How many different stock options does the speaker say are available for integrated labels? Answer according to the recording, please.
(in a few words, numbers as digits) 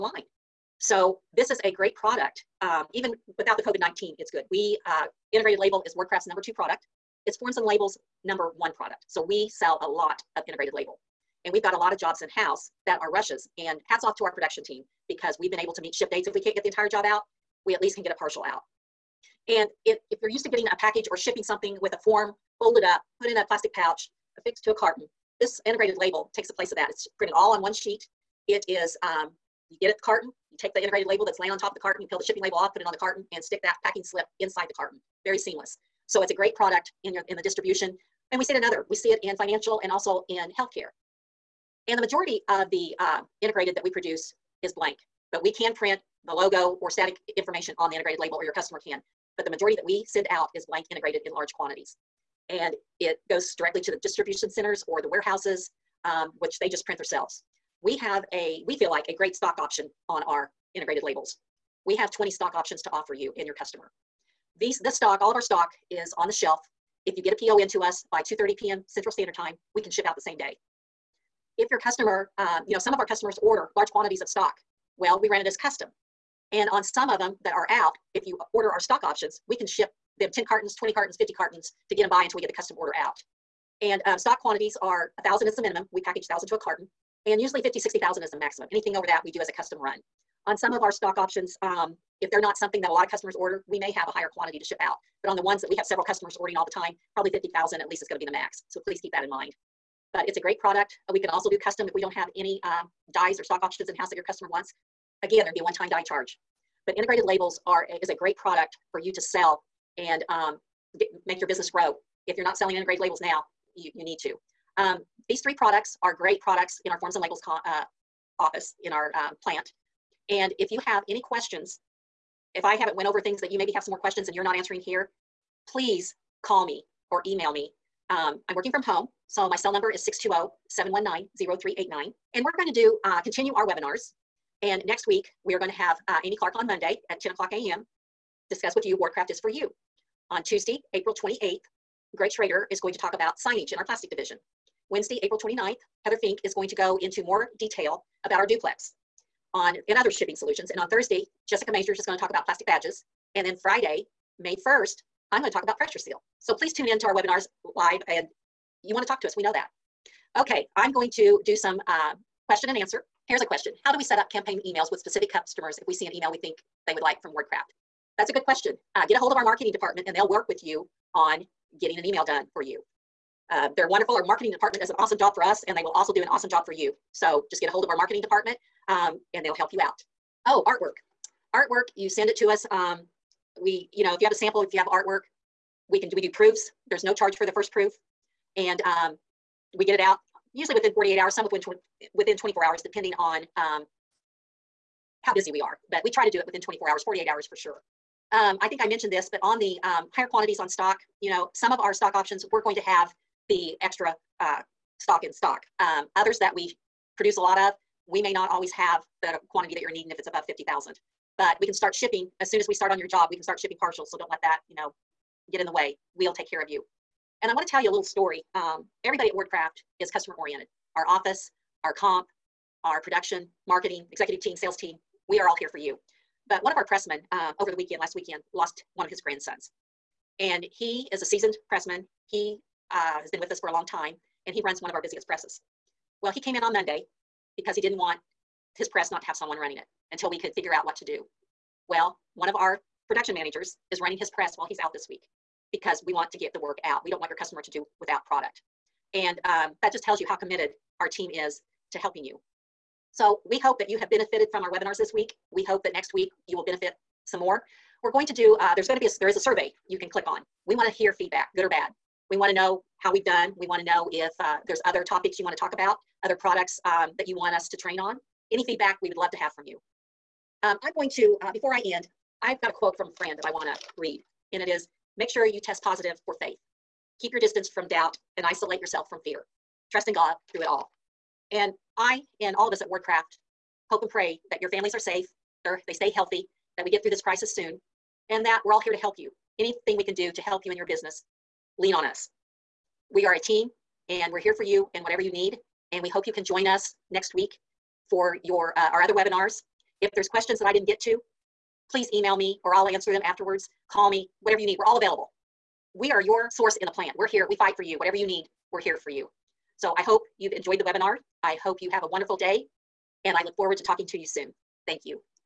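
20.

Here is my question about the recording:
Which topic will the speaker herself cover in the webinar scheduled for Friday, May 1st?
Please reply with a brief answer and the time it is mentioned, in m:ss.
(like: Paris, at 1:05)
Pressure seal, at 2:35.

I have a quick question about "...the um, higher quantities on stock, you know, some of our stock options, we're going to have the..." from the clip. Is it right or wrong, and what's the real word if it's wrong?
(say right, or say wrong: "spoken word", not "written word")
right.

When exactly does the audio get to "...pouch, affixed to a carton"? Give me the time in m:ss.
0:23.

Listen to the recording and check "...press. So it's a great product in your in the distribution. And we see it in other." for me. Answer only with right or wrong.
wrong.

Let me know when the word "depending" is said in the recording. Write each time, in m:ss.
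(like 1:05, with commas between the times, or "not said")
3:12.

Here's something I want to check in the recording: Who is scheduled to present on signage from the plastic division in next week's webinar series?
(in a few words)
Greg Schrader.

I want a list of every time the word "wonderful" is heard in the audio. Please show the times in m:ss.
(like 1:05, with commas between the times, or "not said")
2:53, 5:12.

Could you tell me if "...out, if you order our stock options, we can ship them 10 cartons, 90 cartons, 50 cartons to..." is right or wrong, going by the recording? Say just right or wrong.
wrong.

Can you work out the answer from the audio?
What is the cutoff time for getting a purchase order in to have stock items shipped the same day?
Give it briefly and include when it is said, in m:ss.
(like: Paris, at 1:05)
2:30 p.m. Central, at 1:08.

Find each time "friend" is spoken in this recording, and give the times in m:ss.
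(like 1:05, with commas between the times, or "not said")
4:33.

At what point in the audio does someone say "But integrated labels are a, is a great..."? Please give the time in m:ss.
1:46.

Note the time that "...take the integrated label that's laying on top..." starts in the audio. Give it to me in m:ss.
0:30.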